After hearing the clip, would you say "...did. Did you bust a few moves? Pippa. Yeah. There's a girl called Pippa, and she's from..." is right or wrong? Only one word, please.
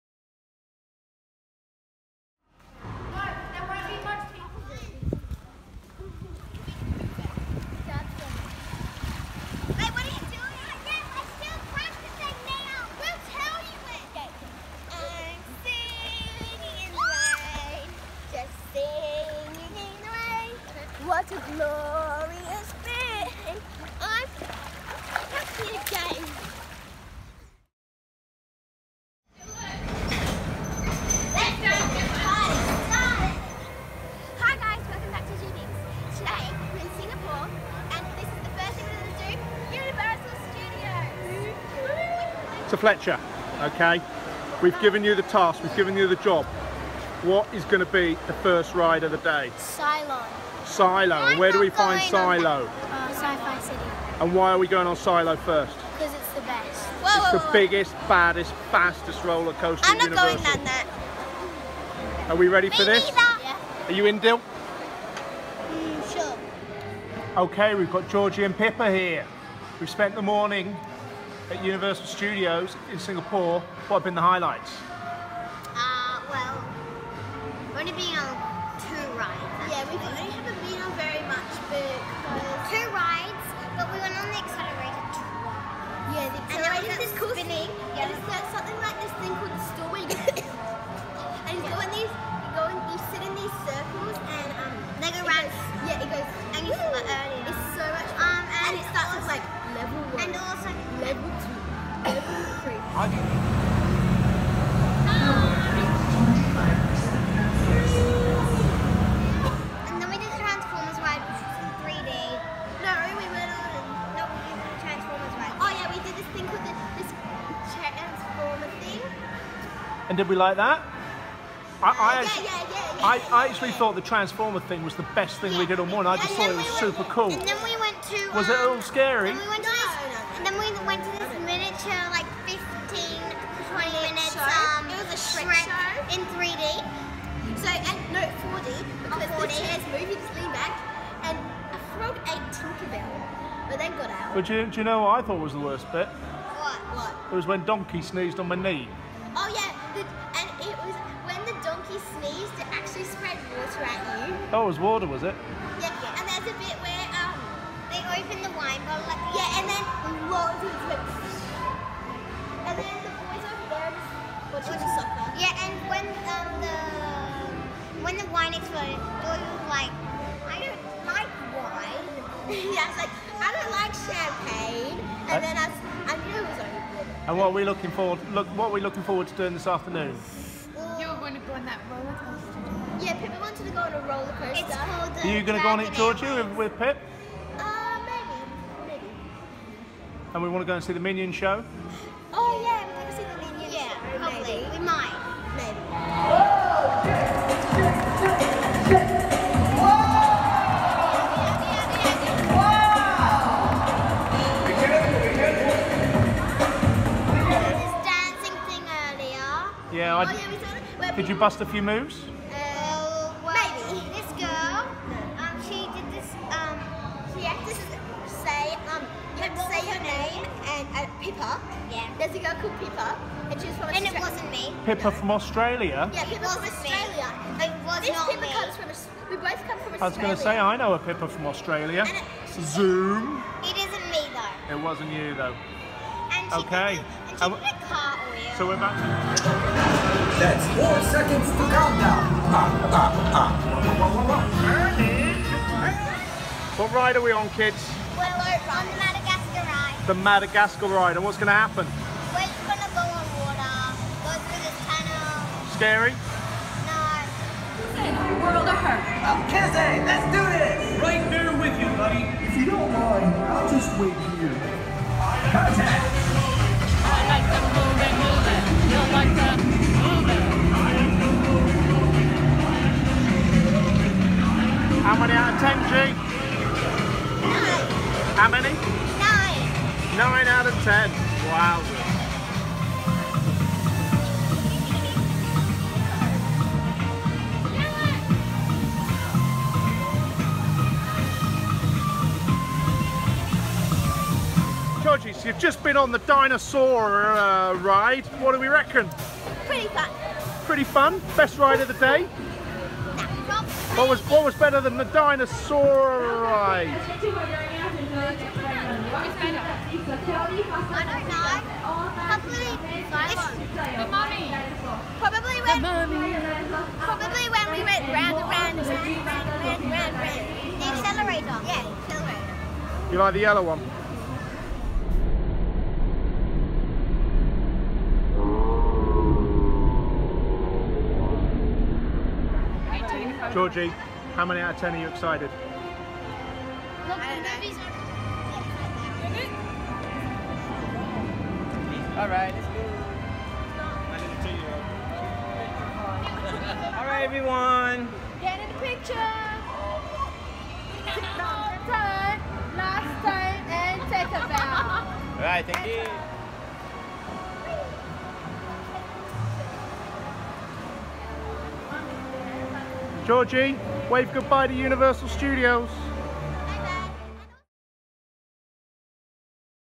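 right.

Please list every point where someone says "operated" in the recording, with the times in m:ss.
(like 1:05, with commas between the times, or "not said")
not said.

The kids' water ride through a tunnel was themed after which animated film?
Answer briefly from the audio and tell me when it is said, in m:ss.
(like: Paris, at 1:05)
Madagascar, at 4:10.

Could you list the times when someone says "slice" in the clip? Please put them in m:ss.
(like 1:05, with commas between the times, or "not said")
not said.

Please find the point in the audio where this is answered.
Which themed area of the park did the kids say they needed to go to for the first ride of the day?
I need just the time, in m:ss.
0:53.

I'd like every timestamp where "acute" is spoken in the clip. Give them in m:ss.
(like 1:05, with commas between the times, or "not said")
not said.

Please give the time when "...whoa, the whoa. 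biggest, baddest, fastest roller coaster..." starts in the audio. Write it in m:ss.
0:57.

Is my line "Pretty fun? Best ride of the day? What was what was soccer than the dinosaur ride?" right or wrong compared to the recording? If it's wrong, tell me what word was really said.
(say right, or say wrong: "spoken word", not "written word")
wrong: "better", not "soccer".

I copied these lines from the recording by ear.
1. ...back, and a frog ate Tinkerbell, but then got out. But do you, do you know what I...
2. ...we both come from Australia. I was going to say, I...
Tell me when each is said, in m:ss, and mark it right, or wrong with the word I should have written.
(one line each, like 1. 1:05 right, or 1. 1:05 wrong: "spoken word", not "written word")
1. 2:20 right
2. 3:49 right.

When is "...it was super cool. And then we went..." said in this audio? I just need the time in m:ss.
2:06.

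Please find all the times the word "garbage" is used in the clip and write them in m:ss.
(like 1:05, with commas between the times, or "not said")
not said.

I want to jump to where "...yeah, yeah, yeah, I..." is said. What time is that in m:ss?
2:02.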